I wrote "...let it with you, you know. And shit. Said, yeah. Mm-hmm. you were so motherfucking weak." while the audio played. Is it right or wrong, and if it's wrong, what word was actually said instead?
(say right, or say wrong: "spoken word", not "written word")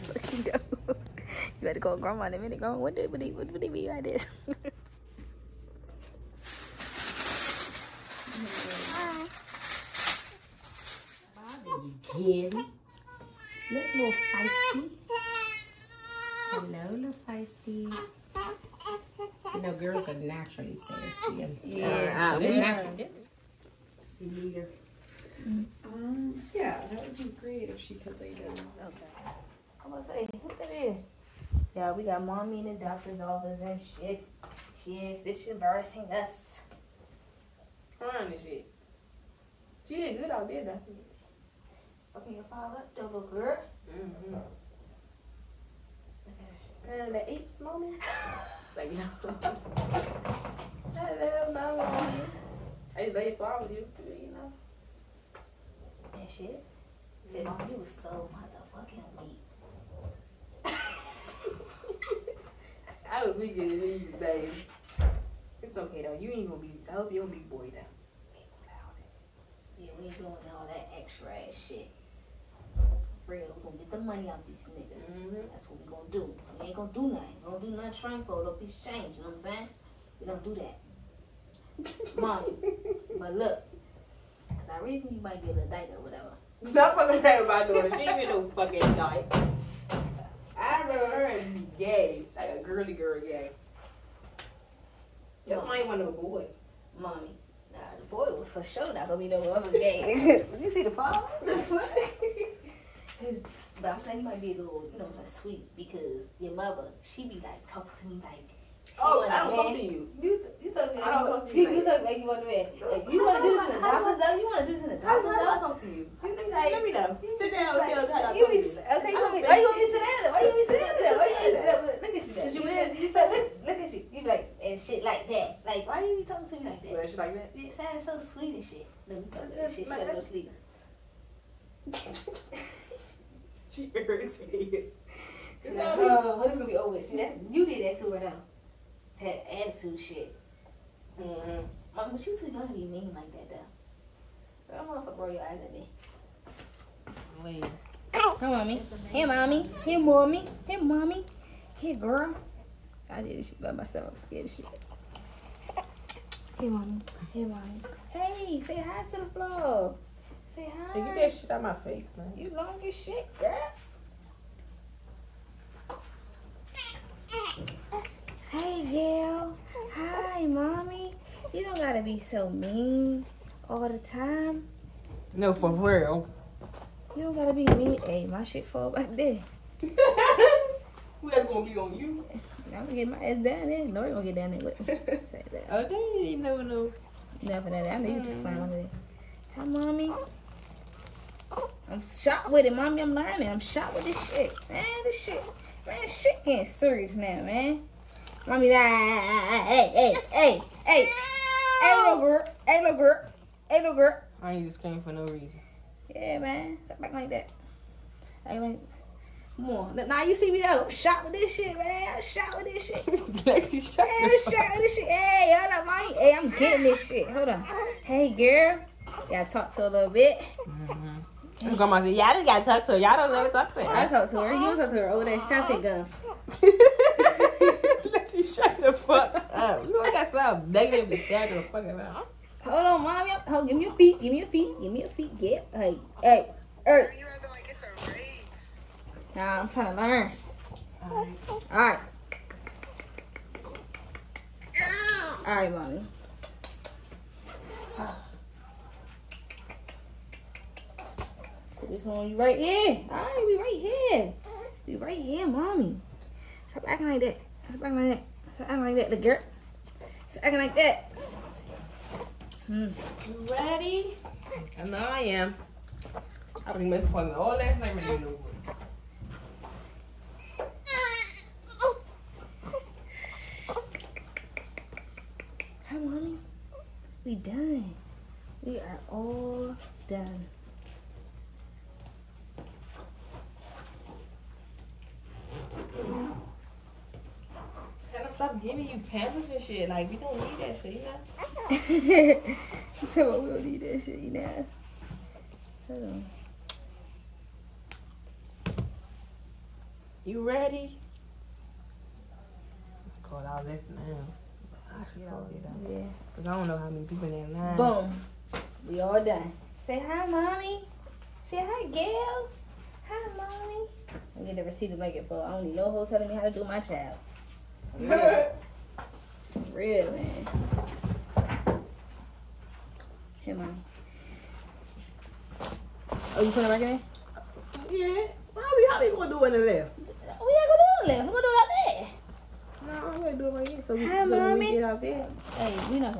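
right.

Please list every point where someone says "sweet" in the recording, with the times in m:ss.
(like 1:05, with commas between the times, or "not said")
1:45, 2:08.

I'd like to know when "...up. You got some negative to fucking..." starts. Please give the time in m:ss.
3:49.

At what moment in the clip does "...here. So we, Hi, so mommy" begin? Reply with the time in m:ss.
5:33.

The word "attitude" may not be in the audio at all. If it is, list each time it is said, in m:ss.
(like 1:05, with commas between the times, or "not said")
2:19.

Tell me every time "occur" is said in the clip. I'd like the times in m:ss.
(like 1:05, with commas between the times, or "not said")
not said.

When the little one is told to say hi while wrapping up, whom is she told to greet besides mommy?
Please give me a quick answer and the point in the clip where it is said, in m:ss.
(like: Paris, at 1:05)
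Gail, at 5:11.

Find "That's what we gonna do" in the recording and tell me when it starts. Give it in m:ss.
1:15.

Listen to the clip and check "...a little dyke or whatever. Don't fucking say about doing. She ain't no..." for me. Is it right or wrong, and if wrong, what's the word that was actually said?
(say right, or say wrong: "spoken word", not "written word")
right.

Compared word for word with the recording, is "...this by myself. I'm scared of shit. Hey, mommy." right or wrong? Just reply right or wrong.
right.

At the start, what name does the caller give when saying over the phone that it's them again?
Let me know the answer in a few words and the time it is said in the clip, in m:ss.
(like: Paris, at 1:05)
Bobby, at 0:11.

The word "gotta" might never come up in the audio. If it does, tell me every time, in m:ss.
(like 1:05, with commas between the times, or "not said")
2:09, 2:51, 2:57, 3:42.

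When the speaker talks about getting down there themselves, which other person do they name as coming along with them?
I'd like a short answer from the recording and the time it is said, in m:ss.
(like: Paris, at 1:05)
Lori, at 3:03.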